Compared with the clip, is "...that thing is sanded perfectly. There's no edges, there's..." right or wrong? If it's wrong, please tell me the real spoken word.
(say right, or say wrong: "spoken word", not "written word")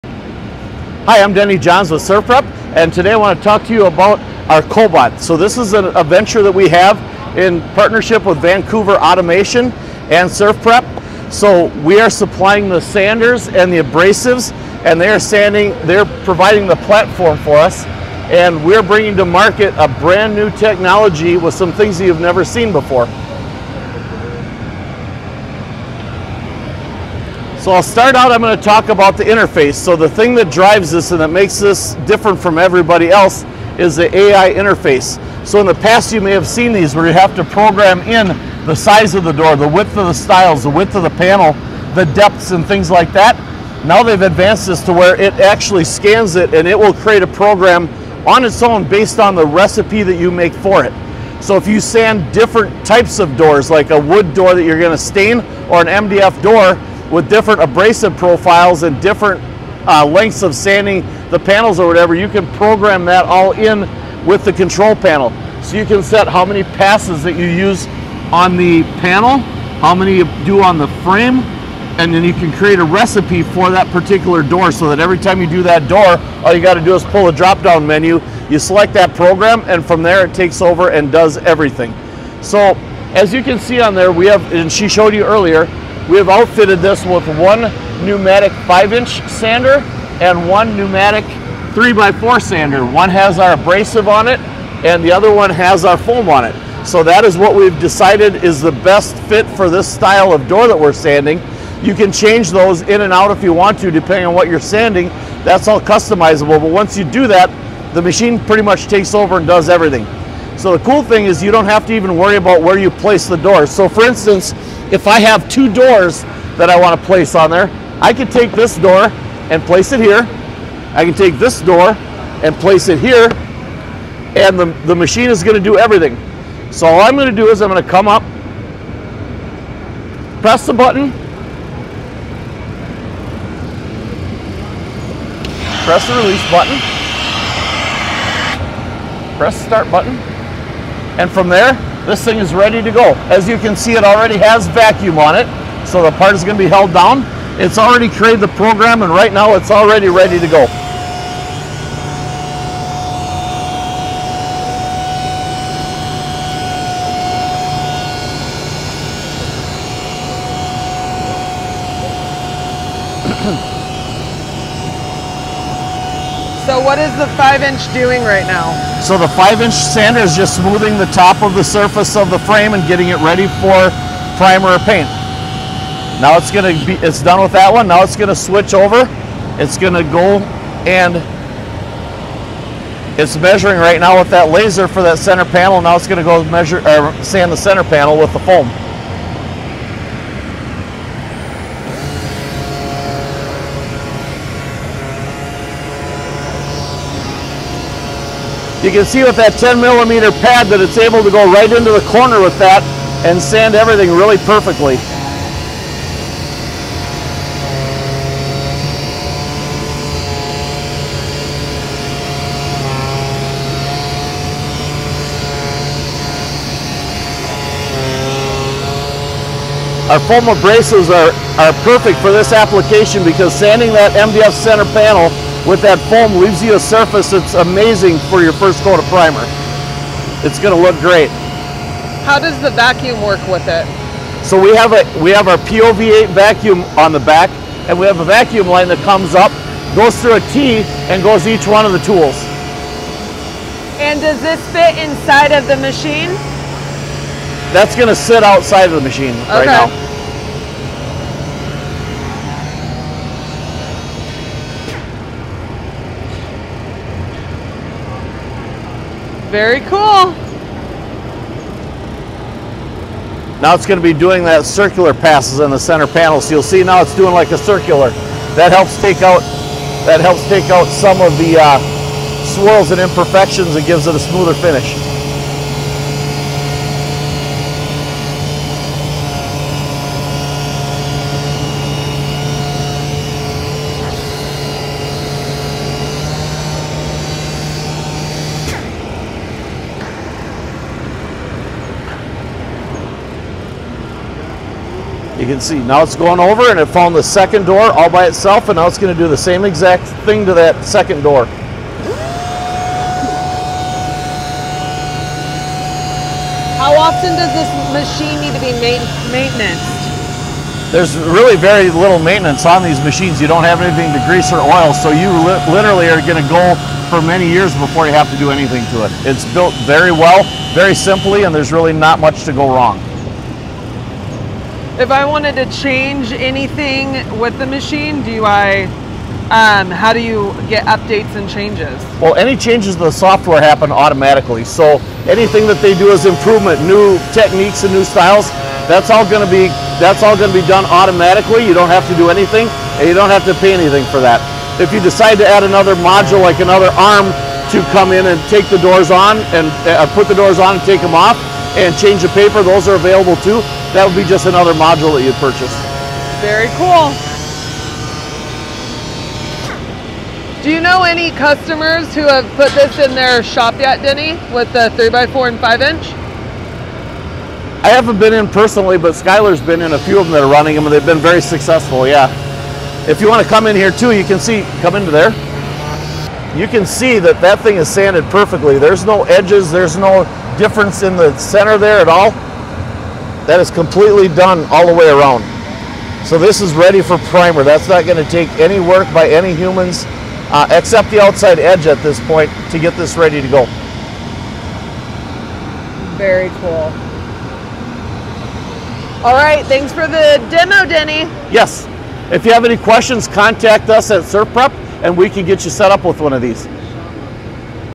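right.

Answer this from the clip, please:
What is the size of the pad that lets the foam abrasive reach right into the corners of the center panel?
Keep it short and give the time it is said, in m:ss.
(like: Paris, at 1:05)
10 millimeter, at 3:19.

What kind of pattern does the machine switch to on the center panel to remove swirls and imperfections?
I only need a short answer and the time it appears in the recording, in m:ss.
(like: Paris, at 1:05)
circular passes, at 4:24.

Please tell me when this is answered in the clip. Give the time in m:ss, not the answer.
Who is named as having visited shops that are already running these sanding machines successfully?
6:09.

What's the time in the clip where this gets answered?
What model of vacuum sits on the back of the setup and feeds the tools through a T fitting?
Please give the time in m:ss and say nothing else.
3:55.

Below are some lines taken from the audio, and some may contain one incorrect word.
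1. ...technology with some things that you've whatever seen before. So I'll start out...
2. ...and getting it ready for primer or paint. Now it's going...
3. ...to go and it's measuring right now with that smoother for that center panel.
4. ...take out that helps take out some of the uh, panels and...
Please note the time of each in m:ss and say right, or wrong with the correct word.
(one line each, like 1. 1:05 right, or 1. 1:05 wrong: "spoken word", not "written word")
1. 0:20 wrong: "never", not "whatever"
2. 2:52 right
3. 2:59 wrong: "laser", not "smoother"
4. 4:29 wrong: "swirls", not "panels".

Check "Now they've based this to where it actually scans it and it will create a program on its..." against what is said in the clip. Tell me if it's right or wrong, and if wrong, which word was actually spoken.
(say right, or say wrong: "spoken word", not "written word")
wrong: "advanced", not "based".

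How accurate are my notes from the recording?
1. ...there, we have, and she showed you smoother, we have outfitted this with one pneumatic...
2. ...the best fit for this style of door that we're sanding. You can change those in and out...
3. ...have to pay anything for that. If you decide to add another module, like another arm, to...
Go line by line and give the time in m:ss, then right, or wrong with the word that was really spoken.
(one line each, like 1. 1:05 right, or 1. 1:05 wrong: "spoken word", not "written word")
1. 1:23 wrong: "earlier", not "smoother"
2. 1:38 right
3. 5:43 right.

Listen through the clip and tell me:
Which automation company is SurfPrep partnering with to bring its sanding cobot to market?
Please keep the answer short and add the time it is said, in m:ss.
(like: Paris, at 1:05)
Vancouver Automation, at 0:08.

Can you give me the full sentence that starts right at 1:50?
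So the cool thing is you don't have to even worry about where you place the doors.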